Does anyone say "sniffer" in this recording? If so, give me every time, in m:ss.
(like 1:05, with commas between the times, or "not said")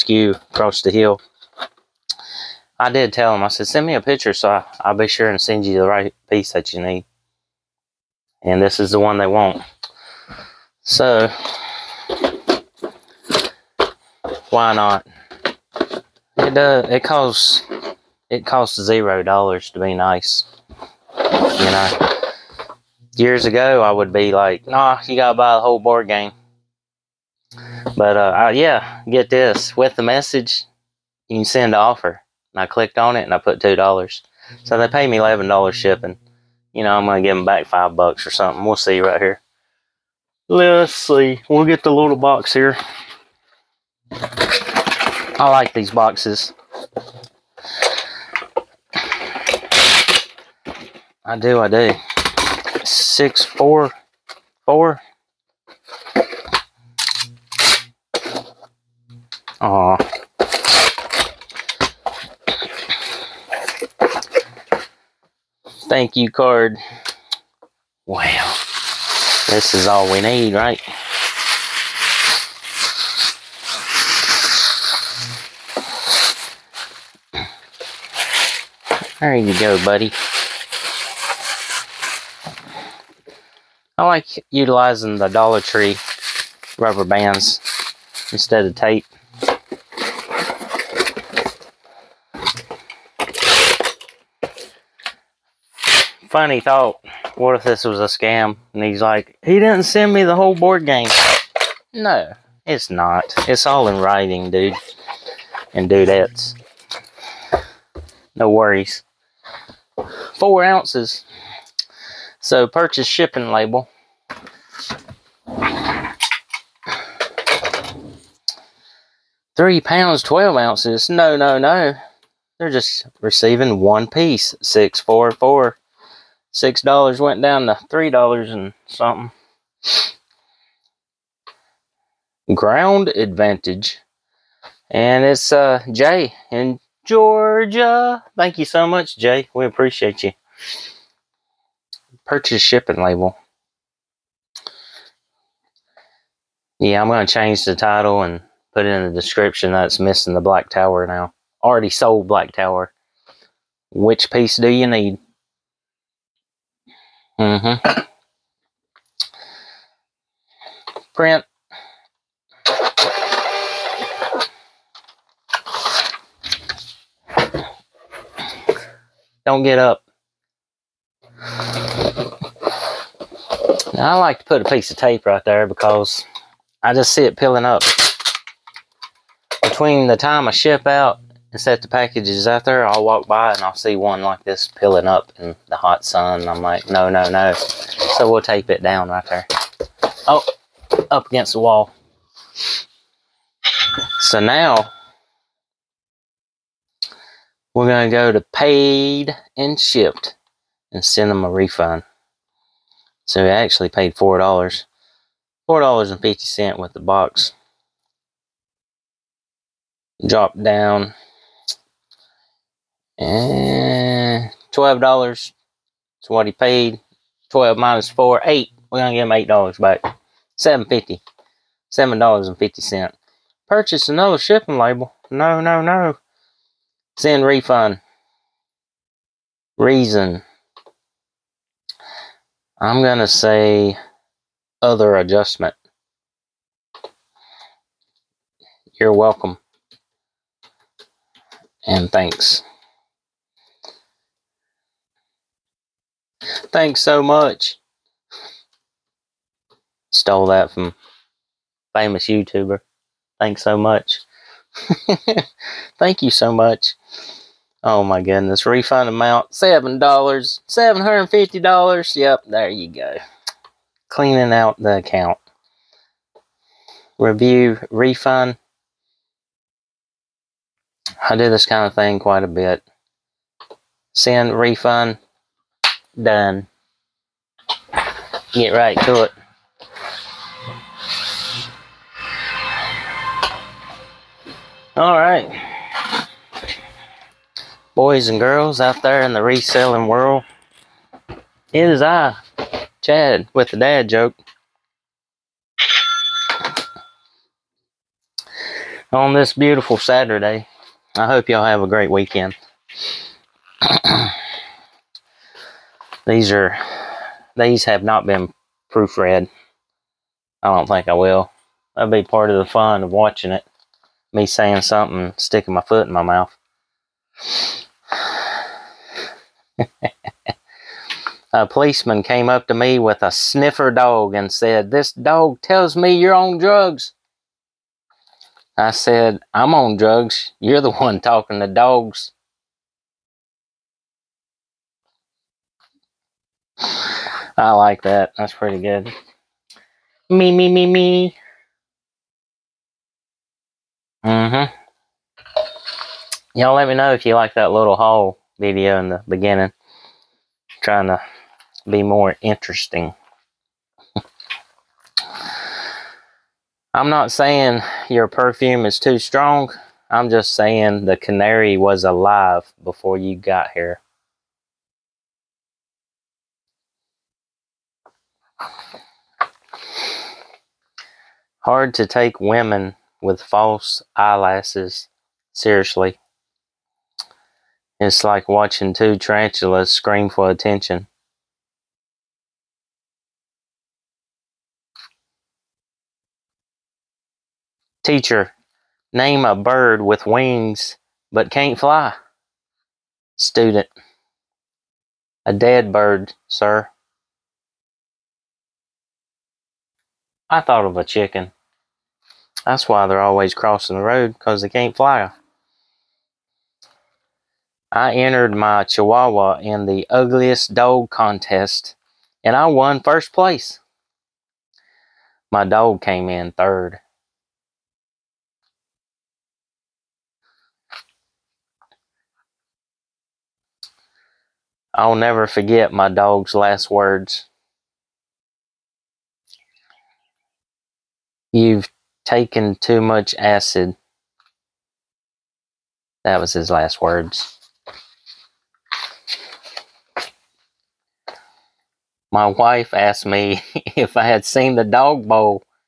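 5:23.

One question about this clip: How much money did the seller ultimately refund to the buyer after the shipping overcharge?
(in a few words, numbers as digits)
$7.50.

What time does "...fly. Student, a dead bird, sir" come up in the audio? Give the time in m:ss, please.
6:31.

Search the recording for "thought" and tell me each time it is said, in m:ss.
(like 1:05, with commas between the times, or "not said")
1:36, 6:40.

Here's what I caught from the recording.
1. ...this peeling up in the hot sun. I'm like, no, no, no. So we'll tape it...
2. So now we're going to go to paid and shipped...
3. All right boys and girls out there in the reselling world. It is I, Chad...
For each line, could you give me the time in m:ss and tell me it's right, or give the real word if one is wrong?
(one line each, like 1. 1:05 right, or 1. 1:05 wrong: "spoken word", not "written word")
1. 3:04 right
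2. 3:14 right
3. 4:44 right.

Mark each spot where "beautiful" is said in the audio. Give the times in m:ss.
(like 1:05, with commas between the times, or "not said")
4:59.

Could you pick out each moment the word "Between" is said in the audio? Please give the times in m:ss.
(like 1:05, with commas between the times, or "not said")
2:59.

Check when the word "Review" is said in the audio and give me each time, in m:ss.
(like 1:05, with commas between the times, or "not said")
4:27.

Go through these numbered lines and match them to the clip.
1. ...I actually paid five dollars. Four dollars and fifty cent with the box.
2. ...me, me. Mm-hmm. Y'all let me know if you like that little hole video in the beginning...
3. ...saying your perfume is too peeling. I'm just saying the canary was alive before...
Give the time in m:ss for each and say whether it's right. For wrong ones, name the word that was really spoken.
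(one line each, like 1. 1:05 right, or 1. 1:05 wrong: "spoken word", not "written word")
1. 3:23 wrong: "four", not "five"
2. 5:40 right
3. 5:57 wrong: "strong", not "peeling".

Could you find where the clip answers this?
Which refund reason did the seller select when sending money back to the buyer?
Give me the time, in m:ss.
3:54.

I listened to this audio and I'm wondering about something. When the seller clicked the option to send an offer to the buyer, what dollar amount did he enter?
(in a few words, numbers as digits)
$2.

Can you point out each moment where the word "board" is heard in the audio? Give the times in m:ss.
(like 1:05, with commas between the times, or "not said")
0:25, 1:40.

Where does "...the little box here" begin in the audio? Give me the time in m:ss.
0:41.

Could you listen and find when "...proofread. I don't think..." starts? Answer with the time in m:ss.
5:08.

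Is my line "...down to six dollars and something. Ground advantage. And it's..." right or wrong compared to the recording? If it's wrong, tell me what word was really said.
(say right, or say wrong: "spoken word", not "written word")
wrong: "three", not "six".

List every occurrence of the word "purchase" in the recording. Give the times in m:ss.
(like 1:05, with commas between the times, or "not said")
1:52, 2:22, 3:43.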